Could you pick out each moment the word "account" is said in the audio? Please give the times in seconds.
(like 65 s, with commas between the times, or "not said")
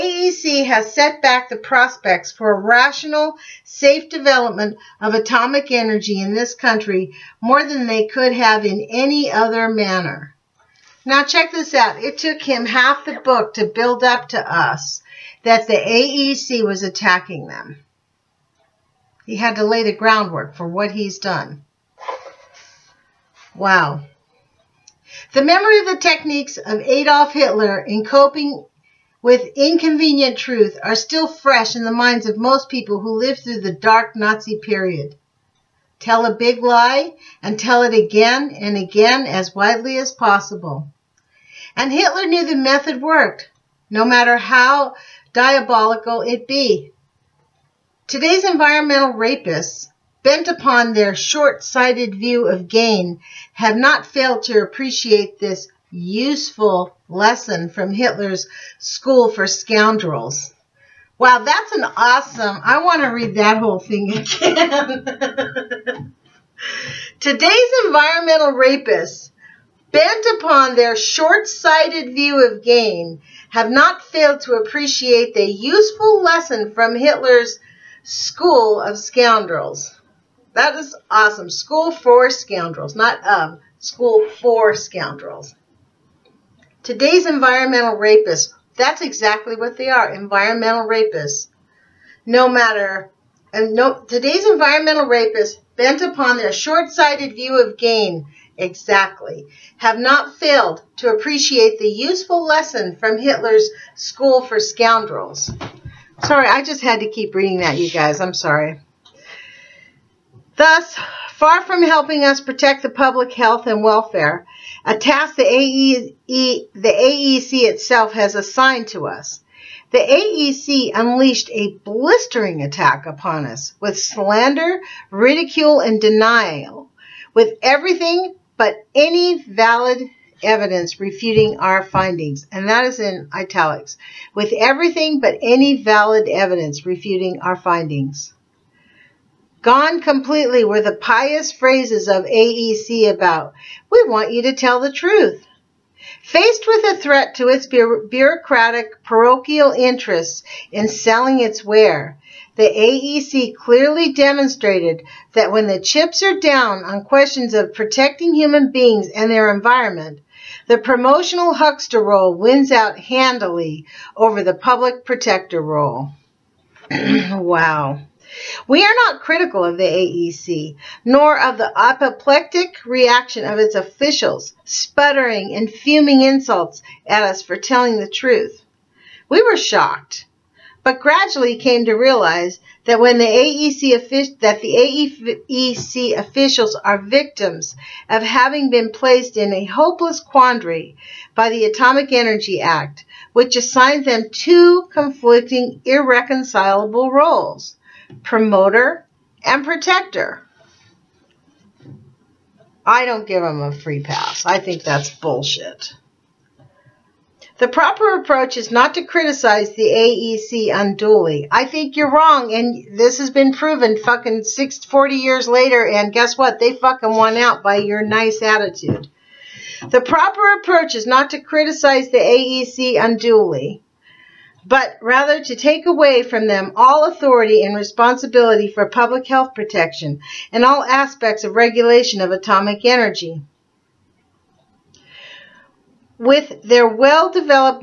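not said.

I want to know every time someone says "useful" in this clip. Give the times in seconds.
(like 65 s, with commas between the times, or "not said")
55 s, 75 s, 101 s.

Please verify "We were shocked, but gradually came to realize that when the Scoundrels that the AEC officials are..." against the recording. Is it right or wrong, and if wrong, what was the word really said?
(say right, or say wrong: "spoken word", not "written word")
wrong: "AEC", not "Scoundrels".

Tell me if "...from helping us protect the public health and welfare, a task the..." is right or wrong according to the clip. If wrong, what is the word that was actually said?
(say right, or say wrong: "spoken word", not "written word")
right.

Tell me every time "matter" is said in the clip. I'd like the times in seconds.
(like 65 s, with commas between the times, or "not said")
44 s, 92 s.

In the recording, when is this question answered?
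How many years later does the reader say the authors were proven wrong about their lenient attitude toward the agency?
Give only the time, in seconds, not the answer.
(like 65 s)
215 s.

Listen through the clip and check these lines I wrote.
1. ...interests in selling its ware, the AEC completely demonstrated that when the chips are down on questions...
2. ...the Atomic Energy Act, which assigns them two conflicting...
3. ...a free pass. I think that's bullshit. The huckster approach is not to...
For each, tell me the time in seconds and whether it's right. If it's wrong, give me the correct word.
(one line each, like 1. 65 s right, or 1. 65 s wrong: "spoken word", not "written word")
1. 149 s wrong: "clearly", not "completely"
2. 191 s right
3. 203 s wrong: "proper", not "huckster".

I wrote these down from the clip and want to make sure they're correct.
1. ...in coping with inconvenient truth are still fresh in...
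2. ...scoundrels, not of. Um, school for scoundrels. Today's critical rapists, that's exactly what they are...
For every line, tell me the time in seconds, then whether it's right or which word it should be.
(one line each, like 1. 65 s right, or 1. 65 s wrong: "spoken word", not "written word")
1. 27 s right
2. 82 s wrong: "environmental", not "critical".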